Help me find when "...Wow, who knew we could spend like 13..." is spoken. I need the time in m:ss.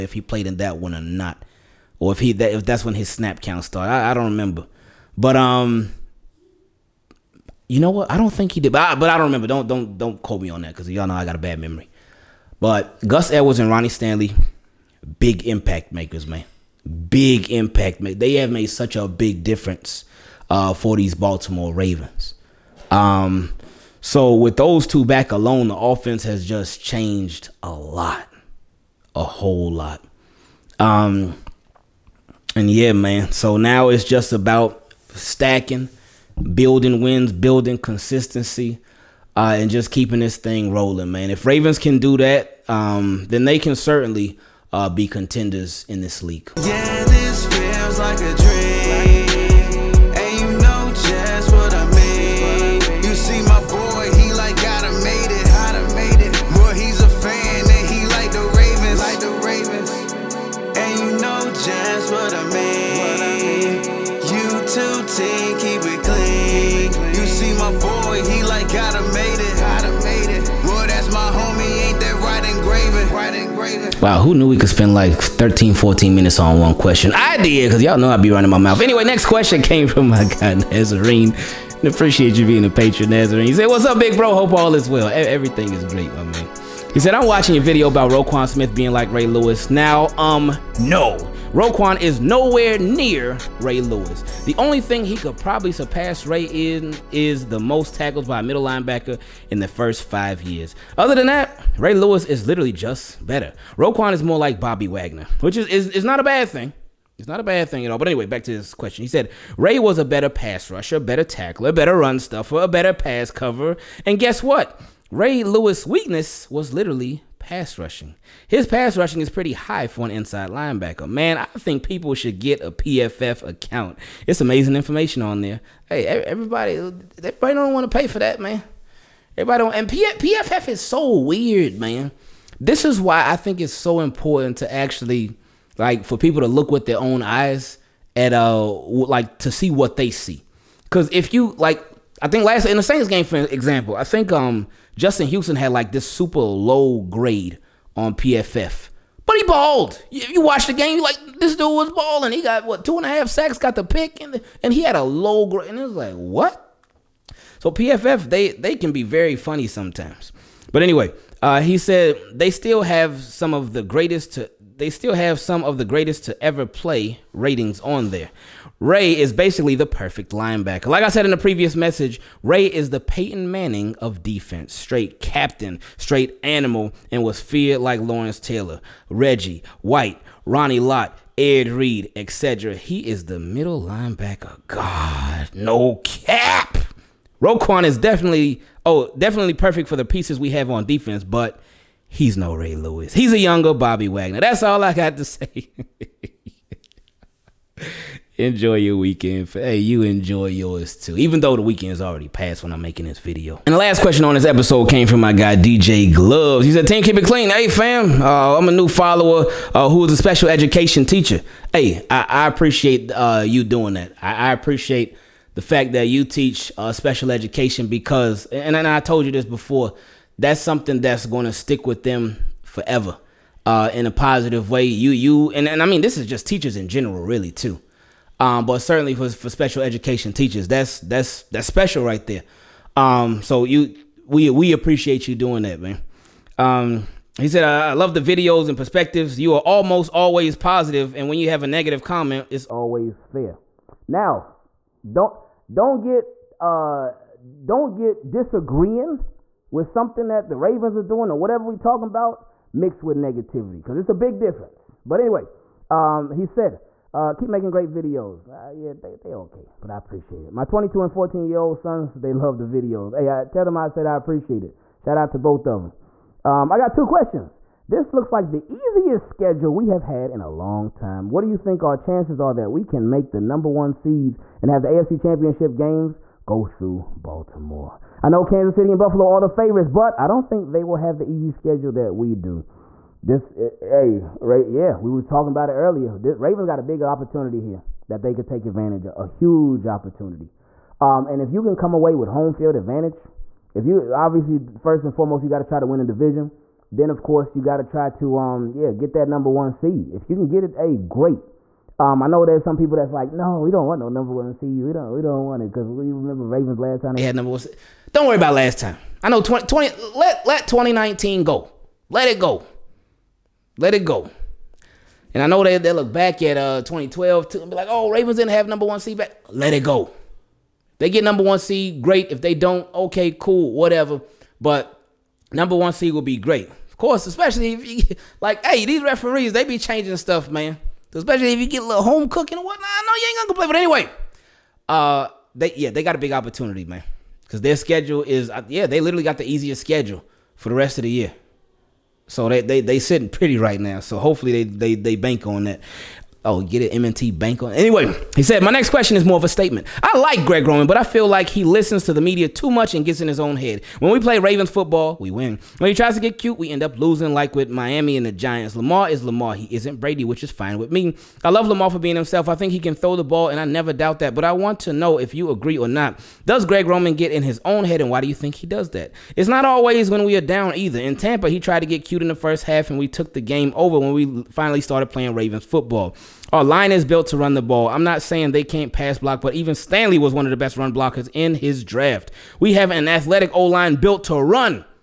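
1:14.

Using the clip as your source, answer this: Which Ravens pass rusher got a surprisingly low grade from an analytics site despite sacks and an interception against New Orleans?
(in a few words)
Justin Houston.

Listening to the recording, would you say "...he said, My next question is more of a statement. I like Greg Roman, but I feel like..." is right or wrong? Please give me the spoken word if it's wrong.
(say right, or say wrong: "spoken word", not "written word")
right.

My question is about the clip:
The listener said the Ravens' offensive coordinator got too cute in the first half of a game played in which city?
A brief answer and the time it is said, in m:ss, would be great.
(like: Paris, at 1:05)
Tampa, at 6:11.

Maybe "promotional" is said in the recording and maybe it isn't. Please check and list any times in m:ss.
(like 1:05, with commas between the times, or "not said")
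not said.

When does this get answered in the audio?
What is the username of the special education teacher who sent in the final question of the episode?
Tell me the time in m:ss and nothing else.
3:25.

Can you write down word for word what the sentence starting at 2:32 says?
He got what two and a half sacks, got the pick, and and he had a low grade.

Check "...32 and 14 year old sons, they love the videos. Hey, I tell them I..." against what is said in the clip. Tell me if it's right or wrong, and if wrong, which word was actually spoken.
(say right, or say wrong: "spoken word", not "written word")
wrong: "22", not "32".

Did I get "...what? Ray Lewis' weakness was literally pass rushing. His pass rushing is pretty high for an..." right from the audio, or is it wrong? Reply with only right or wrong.
right.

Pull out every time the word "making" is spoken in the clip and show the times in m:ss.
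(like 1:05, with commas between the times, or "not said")
3:22, 4:17.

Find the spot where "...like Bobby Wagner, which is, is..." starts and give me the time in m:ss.
1:44.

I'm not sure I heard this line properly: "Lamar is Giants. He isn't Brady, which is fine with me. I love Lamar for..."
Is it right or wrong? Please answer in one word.
wrong.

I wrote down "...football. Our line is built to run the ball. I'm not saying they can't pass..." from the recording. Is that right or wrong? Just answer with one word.
right.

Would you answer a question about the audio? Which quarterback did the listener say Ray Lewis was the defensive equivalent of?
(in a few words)
Peyton Manning.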